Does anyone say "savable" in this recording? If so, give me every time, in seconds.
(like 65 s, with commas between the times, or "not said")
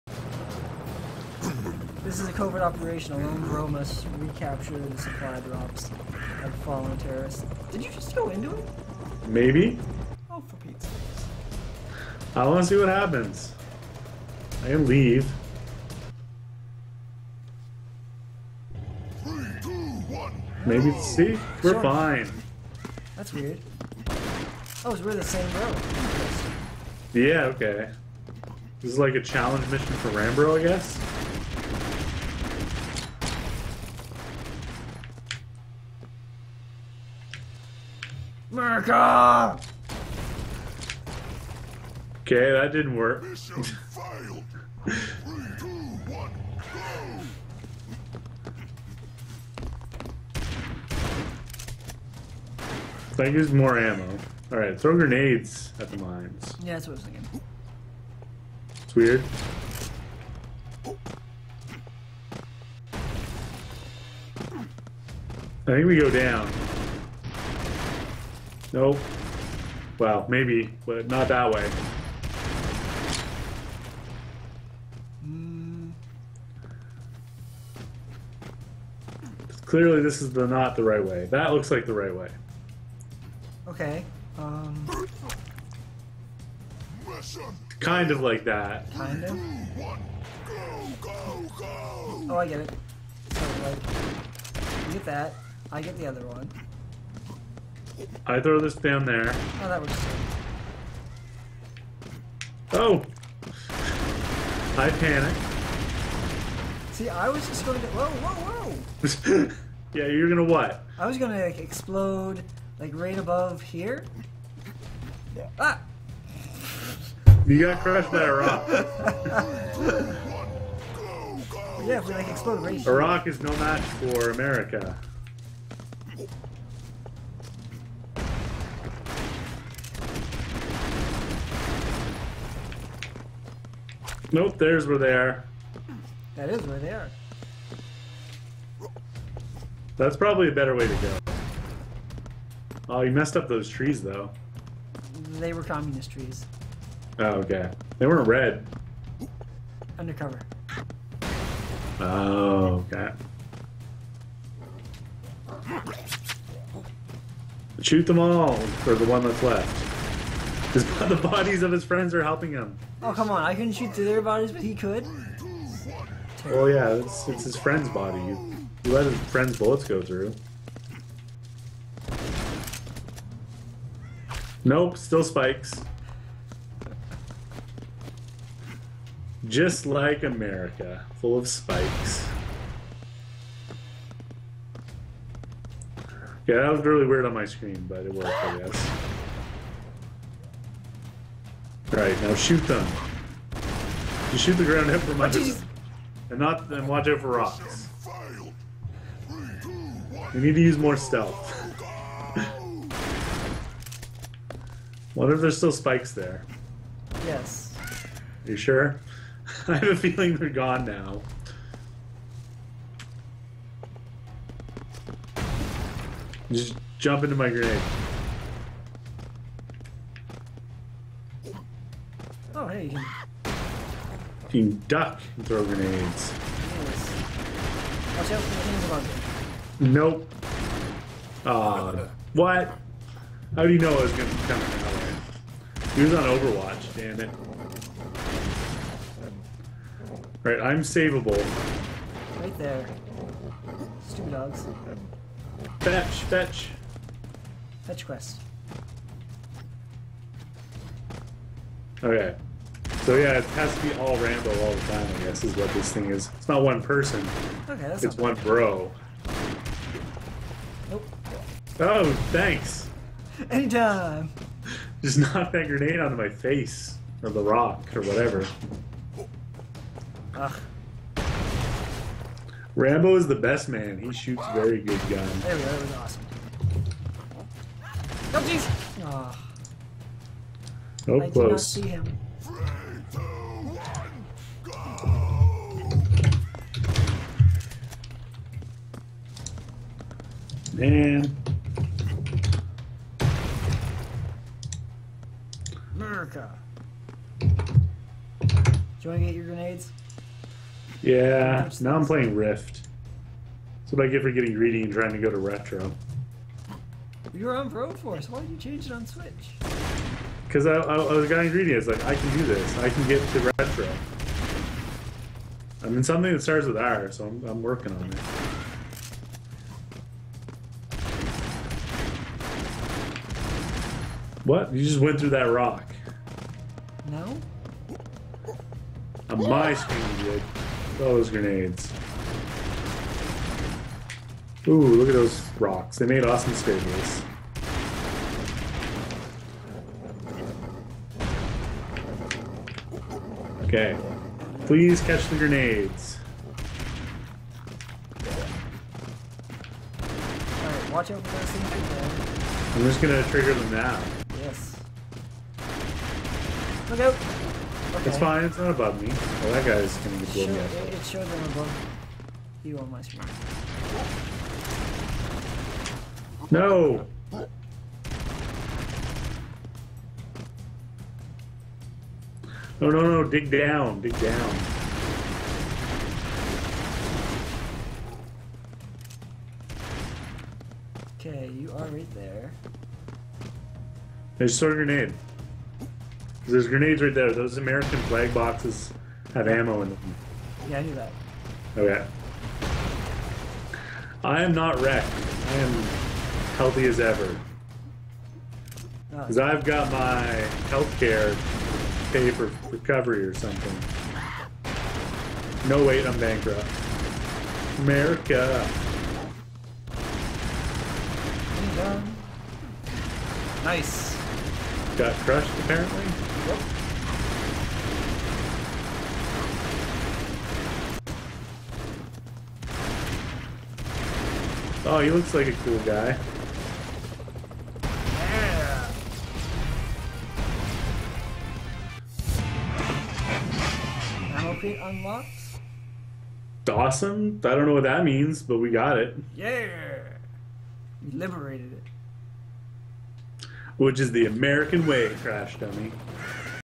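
240 s.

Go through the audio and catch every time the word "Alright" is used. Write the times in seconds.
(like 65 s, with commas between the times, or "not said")
54 s, 348 s.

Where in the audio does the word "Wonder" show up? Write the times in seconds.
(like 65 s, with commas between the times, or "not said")
205 s.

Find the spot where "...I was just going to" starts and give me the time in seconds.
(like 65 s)
107 s.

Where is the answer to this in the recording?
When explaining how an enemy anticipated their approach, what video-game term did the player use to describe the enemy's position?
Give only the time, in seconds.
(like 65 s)
236 s.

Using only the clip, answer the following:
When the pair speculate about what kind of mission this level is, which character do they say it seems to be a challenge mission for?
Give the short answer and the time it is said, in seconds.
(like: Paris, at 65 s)
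Rambro, at 30 s.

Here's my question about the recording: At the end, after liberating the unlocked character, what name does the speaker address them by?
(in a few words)
Crash Dummy.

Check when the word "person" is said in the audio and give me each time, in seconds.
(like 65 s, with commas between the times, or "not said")
256 s.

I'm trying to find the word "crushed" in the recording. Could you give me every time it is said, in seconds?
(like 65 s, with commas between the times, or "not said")
117 s, 415 s.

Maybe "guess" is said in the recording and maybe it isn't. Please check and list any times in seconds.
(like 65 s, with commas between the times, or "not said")
30 s, 188 s, 255 s.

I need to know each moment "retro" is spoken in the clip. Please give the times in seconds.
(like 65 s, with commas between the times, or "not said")
305 s, 313 s.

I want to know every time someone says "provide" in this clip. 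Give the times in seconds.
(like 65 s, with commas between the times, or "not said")
not said.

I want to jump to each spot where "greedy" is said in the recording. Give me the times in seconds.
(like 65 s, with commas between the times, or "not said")
304 s, 311 s.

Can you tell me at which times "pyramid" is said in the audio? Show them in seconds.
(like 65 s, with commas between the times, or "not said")
not said.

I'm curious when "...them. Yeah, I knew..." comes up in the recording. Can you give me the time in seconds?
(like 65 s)
389 s.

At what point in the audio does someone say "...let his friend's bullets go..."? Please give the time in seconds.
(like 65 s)
168 s.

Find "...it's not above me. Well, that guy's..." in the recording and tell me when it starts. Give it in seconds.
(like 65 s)
358 s.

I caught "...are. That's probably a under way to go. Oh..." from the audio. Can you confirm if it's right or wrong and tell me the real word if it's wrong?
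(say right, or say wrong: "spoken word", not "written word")
wrong: "better", not "under".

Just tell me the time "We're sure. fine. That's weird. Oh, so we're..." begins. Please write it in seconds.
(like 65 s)
21 s.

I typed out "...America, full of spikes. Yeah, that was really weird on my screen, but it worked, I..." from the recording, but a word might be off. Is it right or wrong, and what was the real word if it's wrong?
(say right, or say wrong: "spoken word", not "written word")
right.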